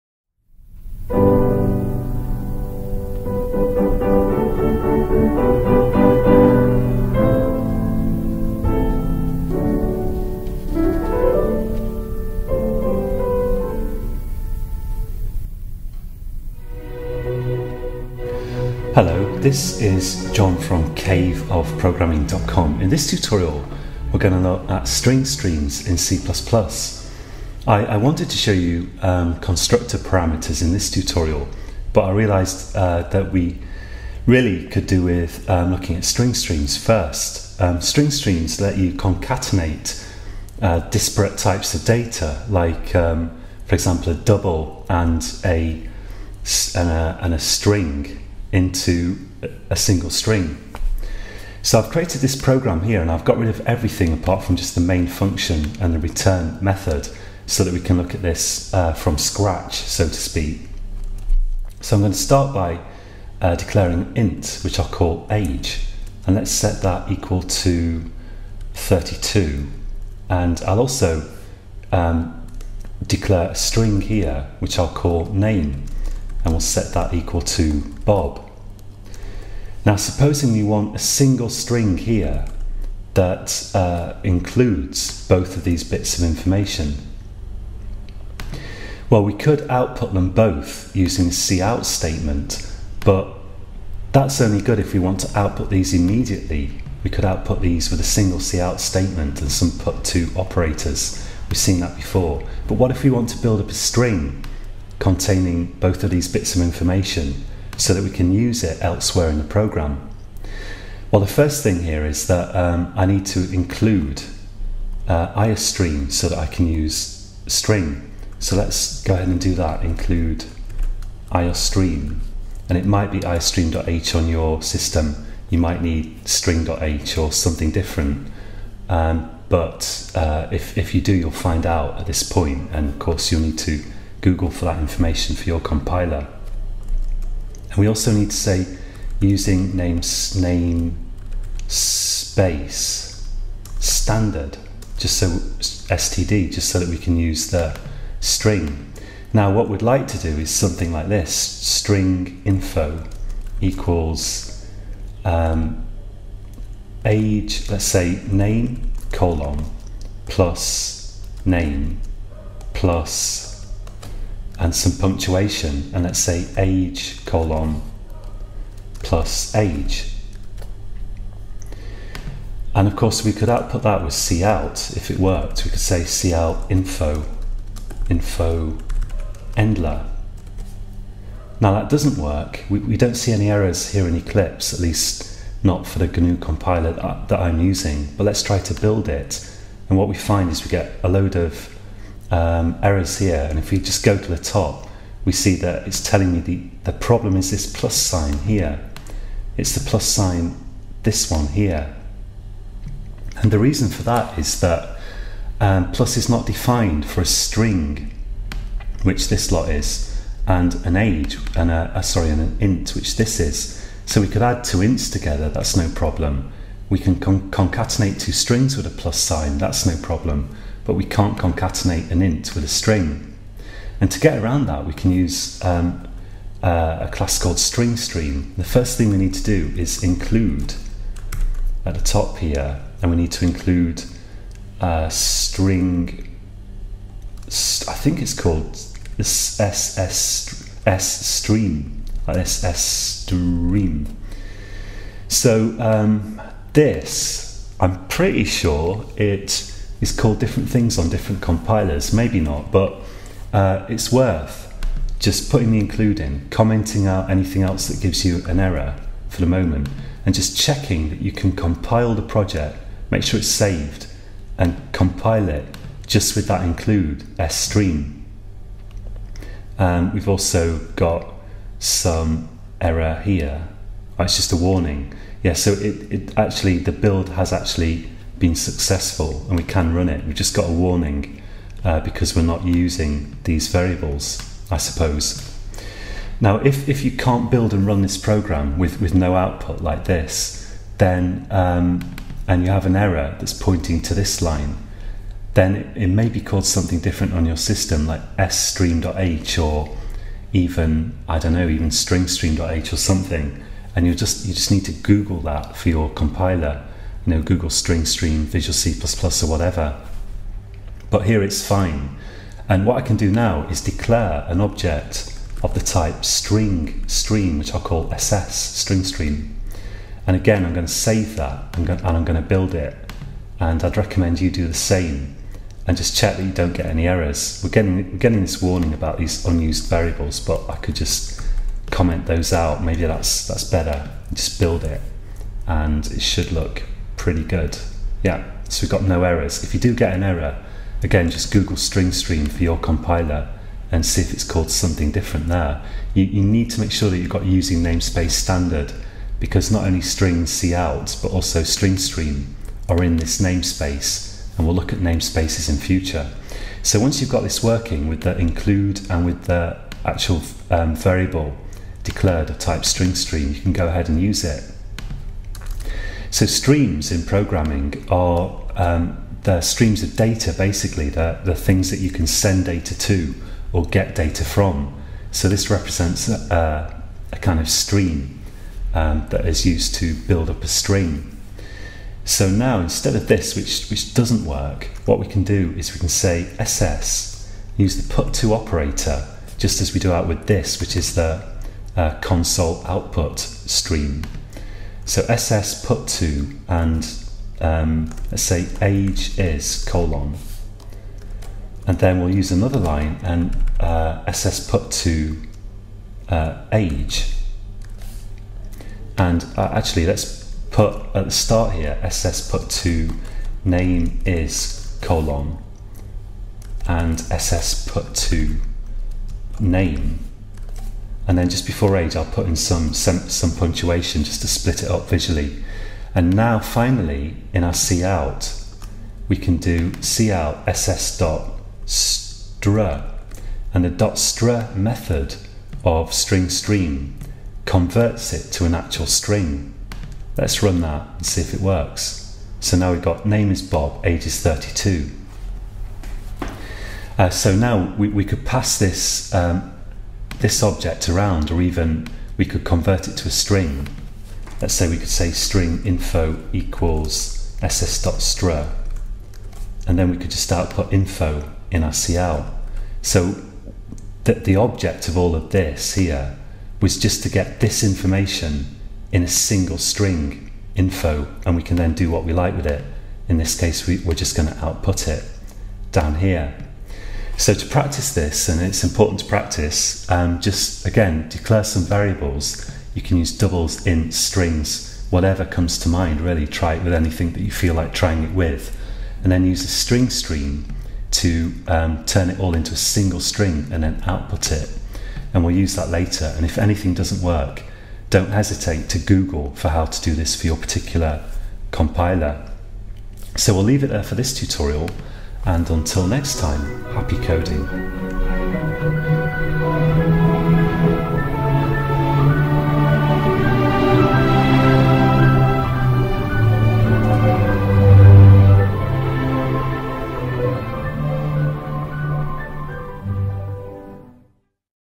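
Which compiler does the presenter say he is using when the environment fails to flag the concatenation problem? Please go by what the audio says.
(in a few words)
GNU.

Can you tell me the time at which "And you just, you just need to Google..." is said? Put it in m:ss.
5:03.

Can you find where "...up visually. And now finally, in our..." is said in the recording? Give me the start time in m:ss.
7:04.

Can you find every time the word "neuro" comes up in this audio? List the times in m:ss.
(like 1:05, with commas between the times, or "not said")
not said.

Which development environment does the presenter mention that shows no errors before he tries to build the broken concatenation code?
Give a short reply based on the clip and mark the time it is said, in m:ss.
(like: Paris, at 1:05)
Eclipse, at 3:04.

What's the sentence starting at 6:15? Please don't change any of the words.
So this represents a, a kind of stream um, that is used to build up a string.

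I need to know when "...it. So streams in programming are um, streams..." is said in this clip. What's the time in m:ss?
6:04.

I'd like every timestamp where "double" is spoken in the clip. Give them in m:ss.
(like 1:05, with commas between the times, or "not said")
0:44, 8:03.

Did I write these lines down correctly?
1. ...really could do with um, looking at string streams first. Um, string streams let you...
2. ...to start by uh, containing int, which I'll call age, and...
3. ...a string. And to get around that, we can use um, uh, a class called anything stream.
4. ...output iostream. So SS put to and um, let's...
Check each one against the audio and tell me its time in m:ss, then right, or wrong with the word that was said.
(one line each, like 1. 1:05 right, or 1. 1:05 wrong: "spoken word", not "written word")
1. 0:34 right
2. 1:02 wrong: "declaring", not "containing"
3. 3:42 wrong: "string", not "anything"
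4. 6:32 wrong: "stream", not "iostream".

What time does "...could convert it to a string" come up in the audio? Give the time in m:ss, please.
7:32.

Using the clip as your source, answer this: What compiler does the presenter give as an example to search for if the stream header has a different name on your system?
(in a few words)
Visual C++.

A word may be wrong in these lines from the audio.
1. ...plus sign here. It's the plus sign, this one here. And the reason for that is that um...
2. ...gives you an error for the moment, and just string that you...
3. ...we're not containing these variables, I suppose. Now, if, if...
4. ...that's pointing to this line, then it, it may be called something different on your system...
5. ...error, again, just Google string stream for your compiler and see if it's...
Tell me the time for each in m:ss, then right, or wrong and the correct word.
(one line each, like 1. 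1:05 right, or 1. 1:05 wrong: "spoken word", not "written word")
1. 3:17 right
2. 4:18 wrong: "checking", not "string"
3. 4:42 wrong: "using", not "containing"
4. 4:53 right
5. 5:40 right.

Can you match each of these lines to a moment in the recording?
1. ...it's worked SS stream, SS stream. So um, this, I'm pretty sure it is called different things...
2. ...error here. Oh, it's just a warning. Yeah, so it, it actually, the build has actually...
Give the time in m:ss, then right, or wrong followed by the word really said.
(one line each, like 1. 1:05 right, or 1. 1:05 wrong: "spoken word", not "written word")
1. 3:58 wrong: "called", not "worked"
2. 4:32 right.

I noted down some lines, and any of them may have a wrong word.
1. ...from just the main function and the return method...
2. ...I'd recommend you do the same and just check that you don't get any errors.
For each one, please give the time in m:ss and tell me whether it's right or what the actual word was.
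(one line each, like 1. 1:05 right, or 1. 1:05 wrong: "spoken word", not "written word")
1. 0:54 right
2. 5:23 right.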